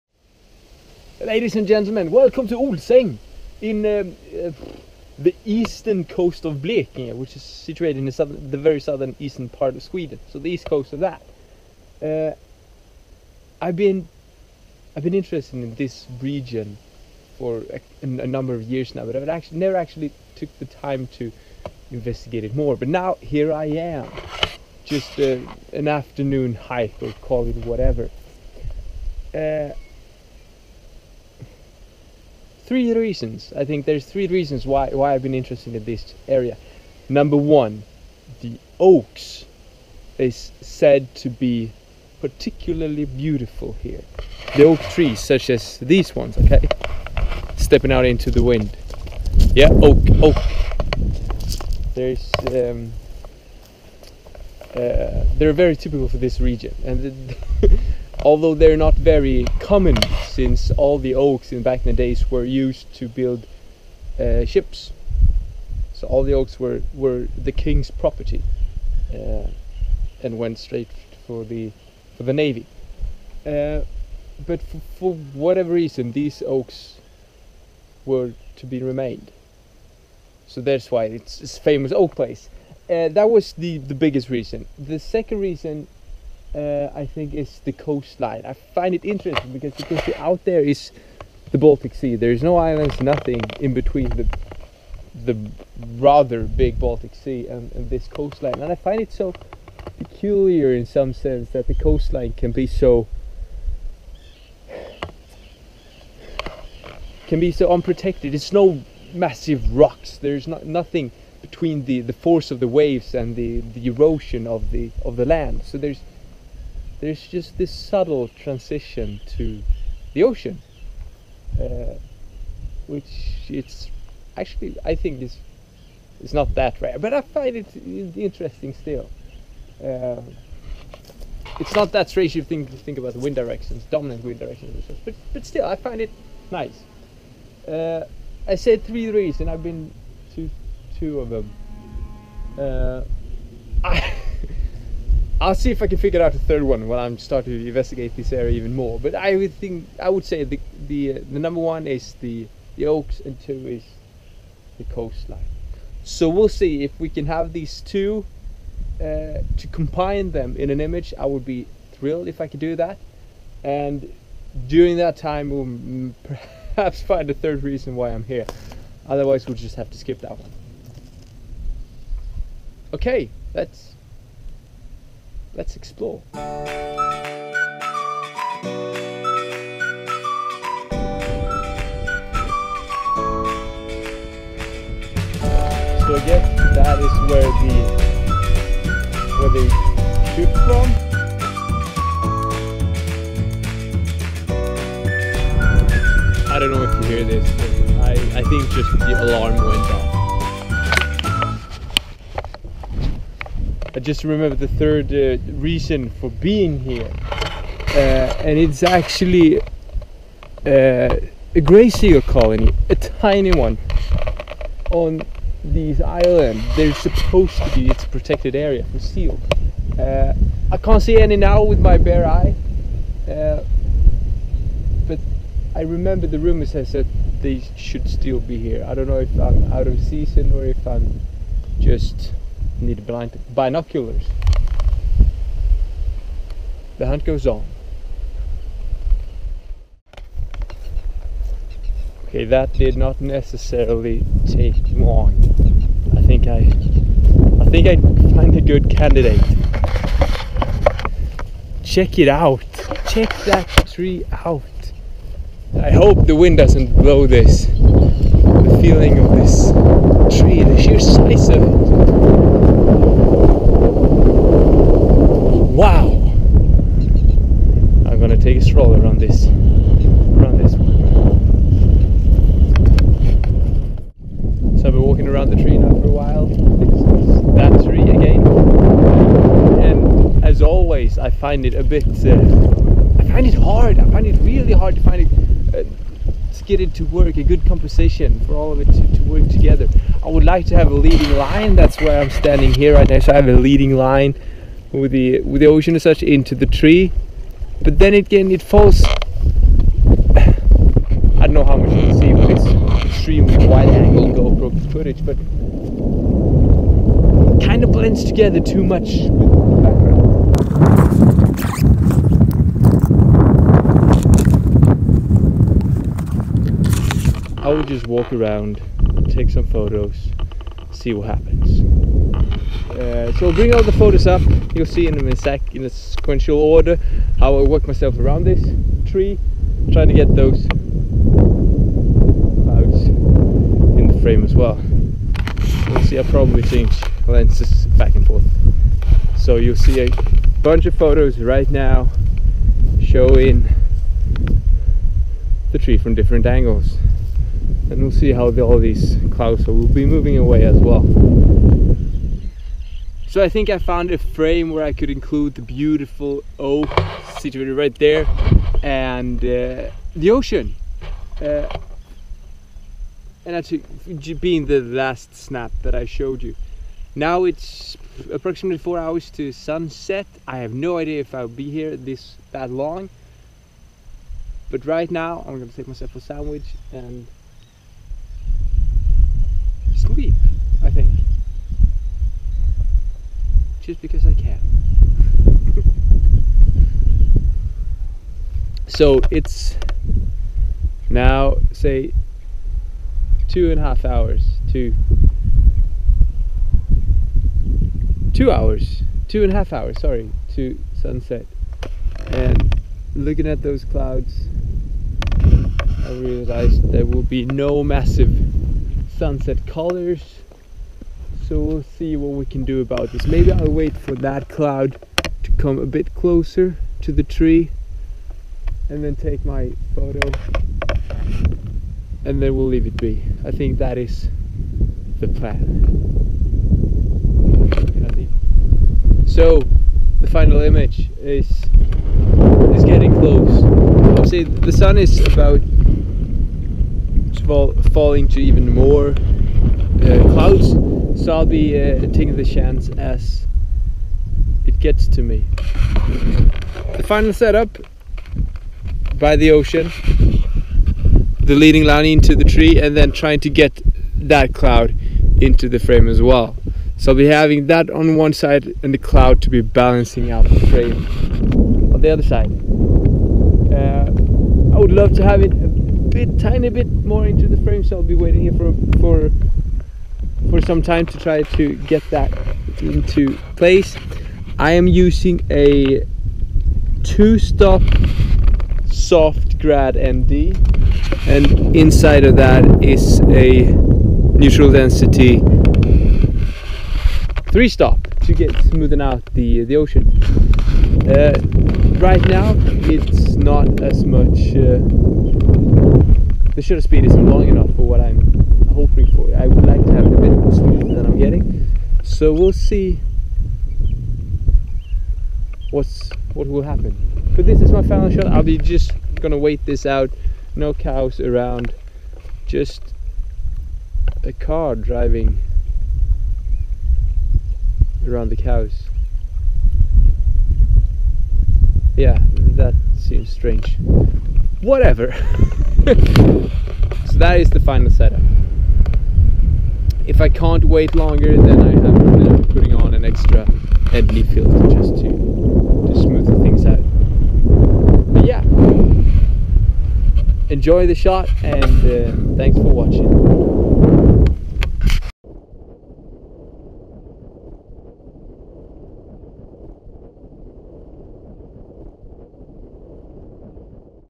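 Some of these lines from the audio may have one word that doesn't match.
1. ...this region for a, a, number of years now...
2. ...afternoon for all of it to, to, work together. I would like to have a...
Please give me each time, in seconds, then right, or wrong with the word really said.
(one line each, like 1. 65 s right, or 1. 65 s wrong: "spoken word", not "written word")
1. 15 s right
2. 287 s wrong: "composition", not "afternoon".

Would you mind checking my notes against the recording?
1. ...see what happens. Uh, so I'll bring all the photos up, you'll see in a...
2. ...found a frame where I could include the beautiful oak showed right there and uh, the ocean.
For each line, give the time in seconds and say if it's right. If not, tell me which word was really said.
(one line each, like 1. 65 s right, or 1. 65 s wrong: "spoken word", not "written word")
1. 320 s right
2. 353 s wrong: "situated", not "showed".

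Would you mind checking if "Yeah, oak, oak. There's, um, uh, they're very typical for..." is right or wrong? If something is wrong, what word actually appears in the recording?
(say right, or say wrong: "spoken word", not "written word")
right.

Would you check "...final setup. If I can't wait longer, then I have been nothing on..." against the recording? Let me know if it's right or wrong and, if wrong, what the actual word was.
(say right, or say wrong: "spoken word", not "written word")
wrong: "putting", not "nothing".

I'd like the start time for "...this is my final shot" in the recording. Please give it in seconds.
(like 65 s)
507 s.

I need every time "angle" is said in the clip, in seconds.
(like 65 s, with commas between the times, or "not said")
303 s, 346 s.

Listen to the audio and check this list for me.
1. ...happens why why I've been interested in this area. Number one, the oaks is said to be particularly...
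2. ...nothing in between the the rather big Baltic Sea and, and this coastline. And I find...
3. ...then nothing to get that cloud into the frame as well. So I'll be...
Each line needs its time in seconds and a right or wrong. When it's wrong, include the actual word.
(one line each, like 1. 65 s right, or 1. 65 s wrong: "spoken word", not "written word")
1. 34 s wrong: "reasons", not "happens"
2. 93 s right
3. 452 s wrong: "trying", not "nothing".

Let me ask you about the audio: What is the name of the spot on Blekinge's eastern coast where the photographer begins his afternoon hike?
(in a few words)
Olsäng.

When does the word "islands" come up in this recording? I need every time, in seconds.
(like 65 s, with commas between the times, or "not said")
92 s, 216 s.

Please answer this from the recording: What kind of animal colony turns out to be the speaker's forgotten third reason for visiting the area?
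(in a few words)
Gray seal.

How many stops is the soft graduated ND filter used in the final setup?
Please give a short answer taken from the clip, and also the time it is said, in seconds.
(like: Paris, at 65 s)
2, at 477 s.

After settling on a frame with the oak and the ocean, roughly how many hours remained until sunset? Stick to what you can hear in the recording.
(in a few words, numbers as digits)
4 hours.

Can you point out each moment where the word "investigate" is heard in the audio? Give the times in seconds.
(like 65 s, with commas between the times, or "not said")
21 s, 147 s.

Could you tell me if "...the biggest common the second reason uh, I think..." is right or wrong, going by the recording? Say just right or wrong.
wrong.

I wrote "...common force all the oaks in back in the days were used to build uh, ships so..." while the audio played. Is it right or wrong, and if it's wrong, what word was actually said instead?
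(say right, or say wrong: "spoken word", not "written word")
wrong: "since", not "force".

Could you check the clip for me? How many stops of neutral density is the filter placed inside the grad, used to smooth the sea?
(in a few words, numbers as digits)
3.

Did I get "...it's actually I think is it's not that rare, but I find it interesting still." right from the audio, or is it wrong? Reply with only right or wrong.
right.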